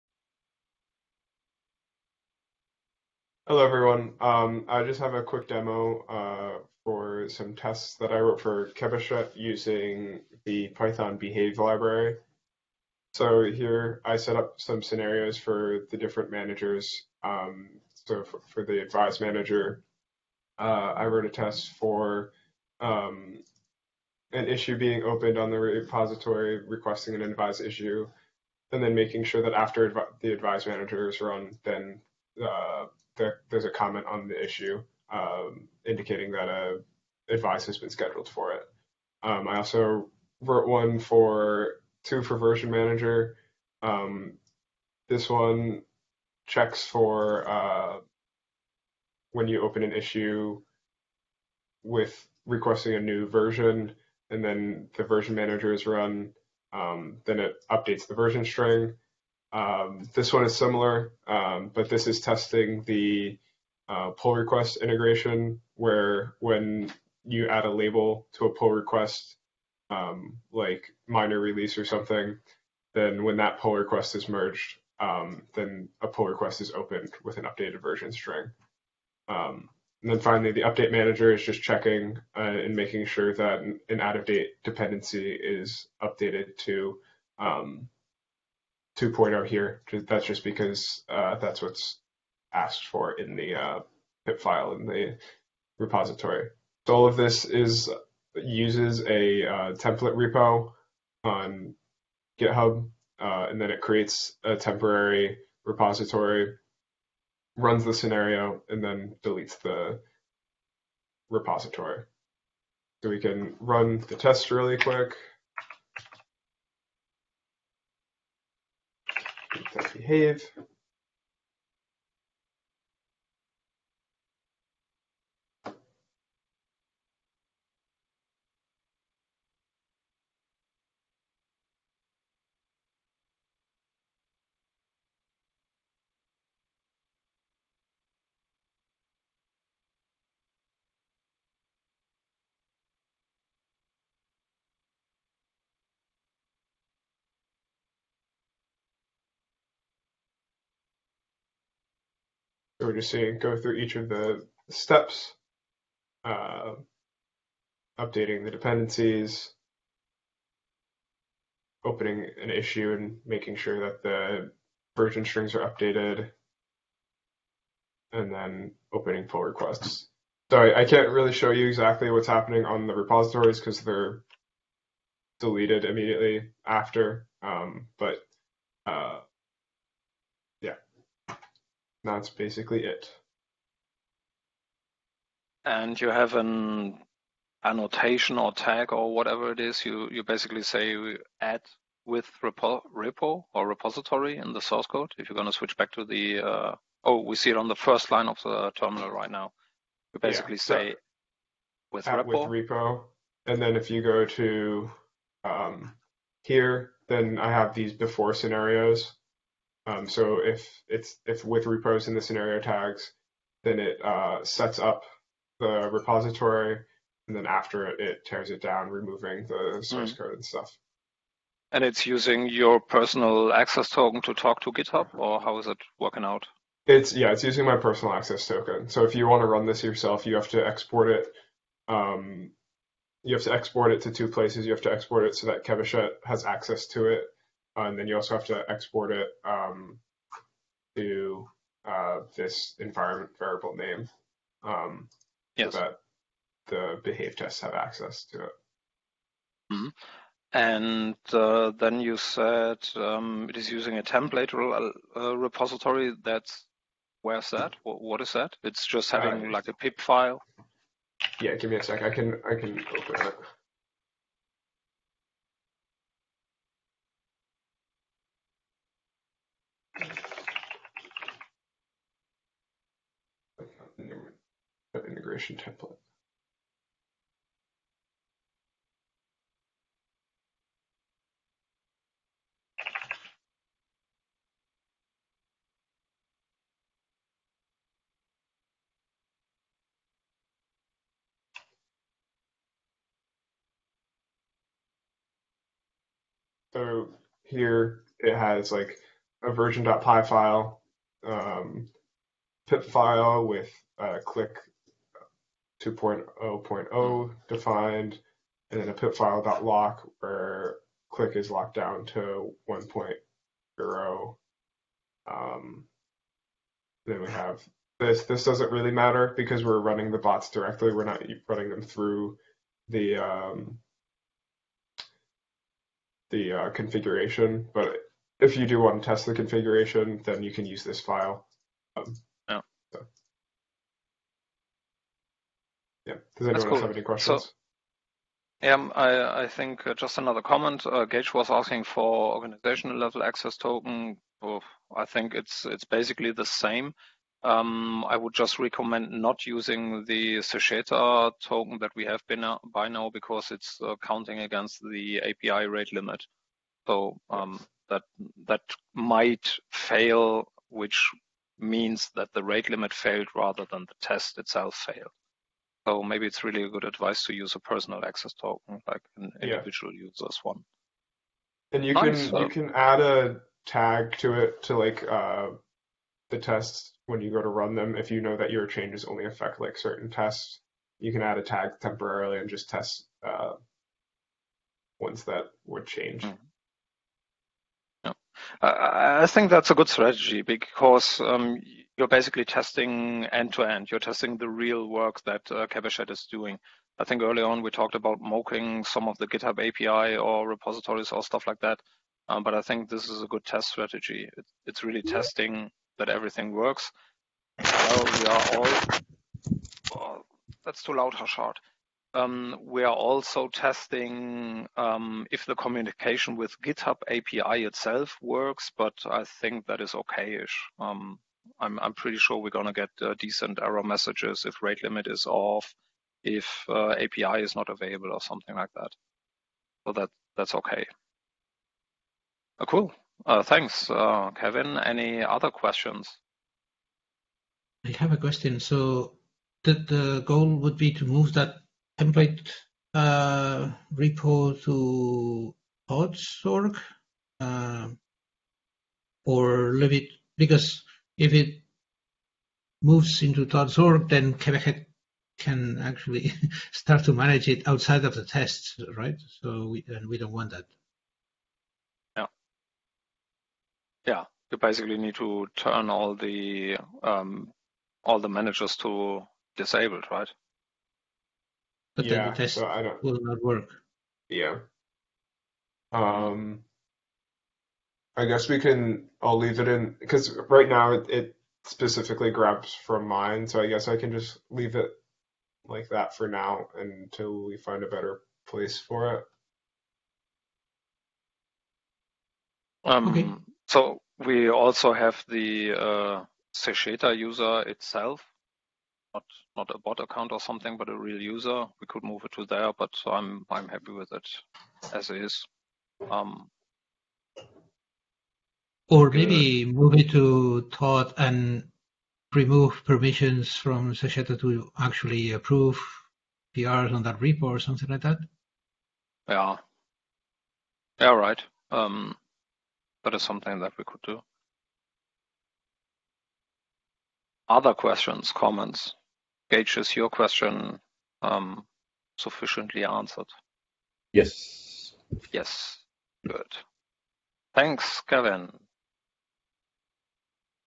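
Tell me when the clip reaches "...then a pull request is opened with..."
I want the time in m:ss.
1:15.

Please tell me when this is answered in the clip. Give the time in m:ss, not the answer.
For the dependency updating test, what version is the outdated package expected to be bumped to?
1:28.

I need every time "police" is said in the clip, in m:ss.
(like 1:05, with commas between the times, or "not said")
not said.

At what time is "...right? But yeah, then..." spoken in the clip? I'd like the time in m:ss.
7:50.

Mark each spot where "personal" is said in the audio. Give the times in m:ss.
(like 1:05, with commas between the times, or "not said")
3:42, 3:47, 6:07.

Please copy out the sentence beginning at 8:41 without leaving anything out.
Um, that is something that we could do.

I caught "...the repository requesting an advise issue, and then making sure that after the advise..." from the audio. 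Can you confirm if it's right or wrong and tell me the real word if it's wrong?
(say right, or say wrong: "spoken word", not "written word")
right.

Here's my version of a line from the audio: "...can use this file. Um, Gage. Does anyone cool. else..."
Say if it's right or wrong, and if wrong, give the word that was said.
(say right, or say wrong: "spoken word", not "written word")
wrong: "Yeah", not "Gage".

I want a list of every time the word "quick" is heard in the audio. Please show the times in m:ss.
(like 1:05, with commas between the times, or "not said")
0:05, 1:54.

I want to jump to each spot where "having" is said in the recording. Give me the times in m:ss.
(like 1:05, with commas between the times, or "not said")
4:19.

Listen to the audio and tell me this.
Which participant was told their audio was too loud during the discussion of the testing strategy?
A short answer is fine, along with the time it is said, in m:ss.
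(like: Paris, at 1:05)
Harshad, at 6:51.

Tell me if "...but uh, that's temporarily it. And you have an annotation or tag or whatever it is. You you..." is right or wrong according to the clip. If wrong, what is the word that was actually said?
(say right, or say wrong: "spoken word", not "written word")
wrong: "basically", not "temporarily".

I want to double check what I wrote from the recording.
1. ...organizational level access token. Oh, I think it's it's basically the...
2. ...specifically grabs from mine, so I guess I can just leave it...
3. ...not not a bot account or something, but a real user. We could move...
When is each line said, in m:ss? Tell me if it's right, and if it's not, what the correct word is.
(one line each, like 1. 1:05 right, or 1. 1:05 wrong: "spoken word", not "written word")
1. 5:42 right
2. 8:01 right
3. 8:19 right.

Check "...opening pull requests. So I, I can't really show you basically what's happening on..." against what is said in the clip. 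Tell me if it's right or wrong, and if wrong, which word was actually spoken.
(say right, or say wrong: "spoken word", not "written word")
wrong: "exactly", not "basically".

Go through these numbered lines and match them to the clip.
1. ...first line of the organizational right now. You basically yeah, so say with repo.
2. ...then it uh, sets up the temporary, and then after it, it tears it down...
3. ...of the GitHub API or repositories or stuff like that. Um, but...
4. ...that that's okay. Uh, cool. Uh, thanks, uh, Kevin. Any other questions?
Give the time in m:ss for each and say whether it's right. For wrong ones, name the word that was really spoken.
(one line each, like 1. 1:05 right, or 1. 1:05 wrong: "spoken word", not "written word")
1. 3:17 wrong: "terminal", not "organizational"
2. 3:33 wrong: "repository", not "temporary"
3. 6:39 right
4. 7:09 right.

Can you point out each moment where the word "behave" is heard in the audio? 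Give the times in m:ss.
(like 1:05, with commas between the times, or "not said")
0:11, 1:59, 4:07.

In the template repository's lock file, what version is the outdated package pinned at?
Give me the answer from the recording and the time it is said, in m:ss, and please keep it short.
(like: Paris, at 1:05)
1.0, at 5:12.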